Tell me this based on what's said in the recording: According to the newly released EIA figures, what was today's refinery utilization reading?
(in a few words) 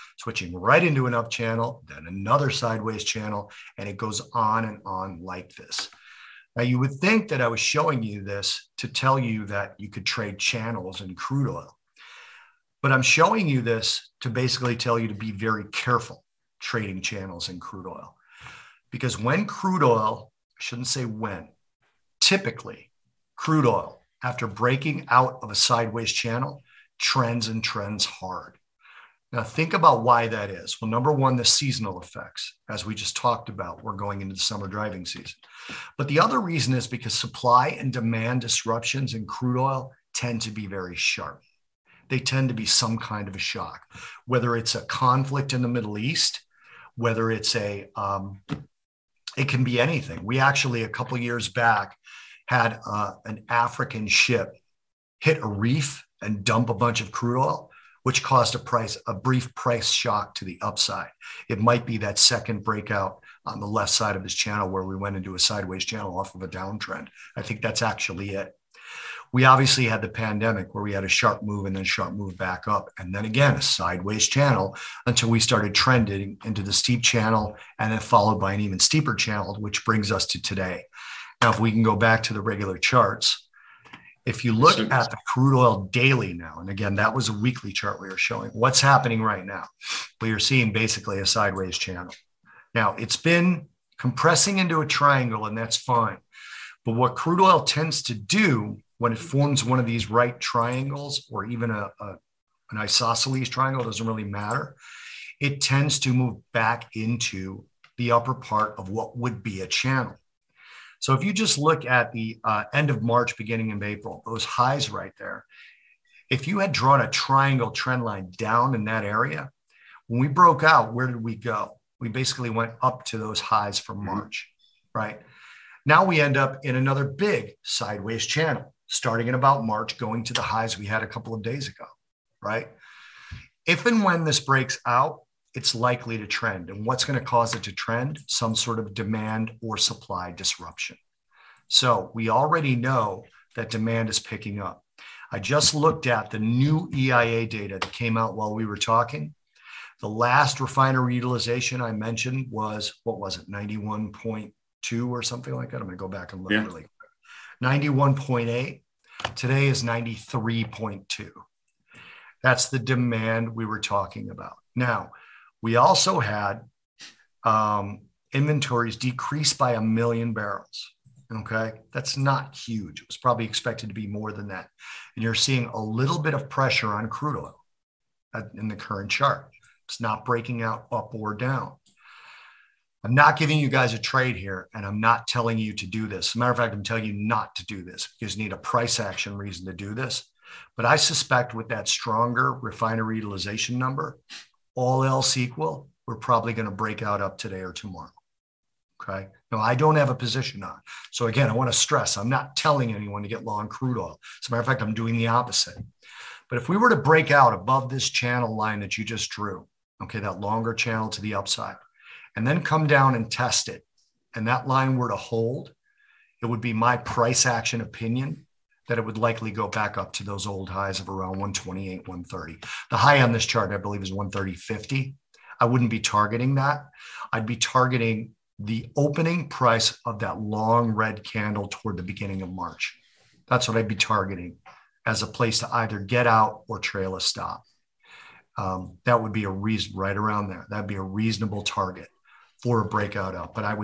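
93.2.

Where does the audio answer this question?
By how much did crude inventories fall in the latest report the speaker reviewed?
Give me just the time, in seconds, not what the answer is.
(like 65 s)
169 s.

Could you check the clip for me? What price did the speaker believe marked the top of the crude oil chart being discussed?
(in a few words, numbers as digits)
130.50.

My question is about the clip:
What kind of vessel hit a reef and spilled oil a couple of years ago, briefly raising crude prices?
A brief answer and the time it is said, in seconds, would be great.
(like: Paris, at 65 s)
An African ship, at 53 s.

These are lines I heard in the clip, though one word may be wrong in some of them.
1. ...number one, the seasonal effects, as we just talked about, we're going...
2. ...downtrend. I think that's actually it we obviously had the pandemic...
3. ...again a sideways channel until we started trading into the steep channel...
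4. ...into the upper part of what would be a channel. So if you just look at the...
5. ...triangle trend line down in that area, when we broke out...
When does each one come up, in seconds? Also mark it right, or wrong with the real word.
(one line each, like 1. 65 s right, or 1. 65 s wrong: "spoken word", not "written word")
1. 30 s right
2. 66 s right
3. 73 s wrong: "trending", not "trading"
4. 106 s right
5. 117 s right.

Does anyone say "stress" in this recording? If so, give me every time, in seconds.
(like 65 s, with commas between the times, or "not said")
201 s.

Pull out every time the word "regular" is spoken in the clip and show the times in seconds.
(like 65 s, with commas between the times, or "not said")
82 s.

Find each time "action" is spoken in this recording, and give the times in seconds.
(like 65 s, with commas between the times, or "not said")
188 s, 217 s.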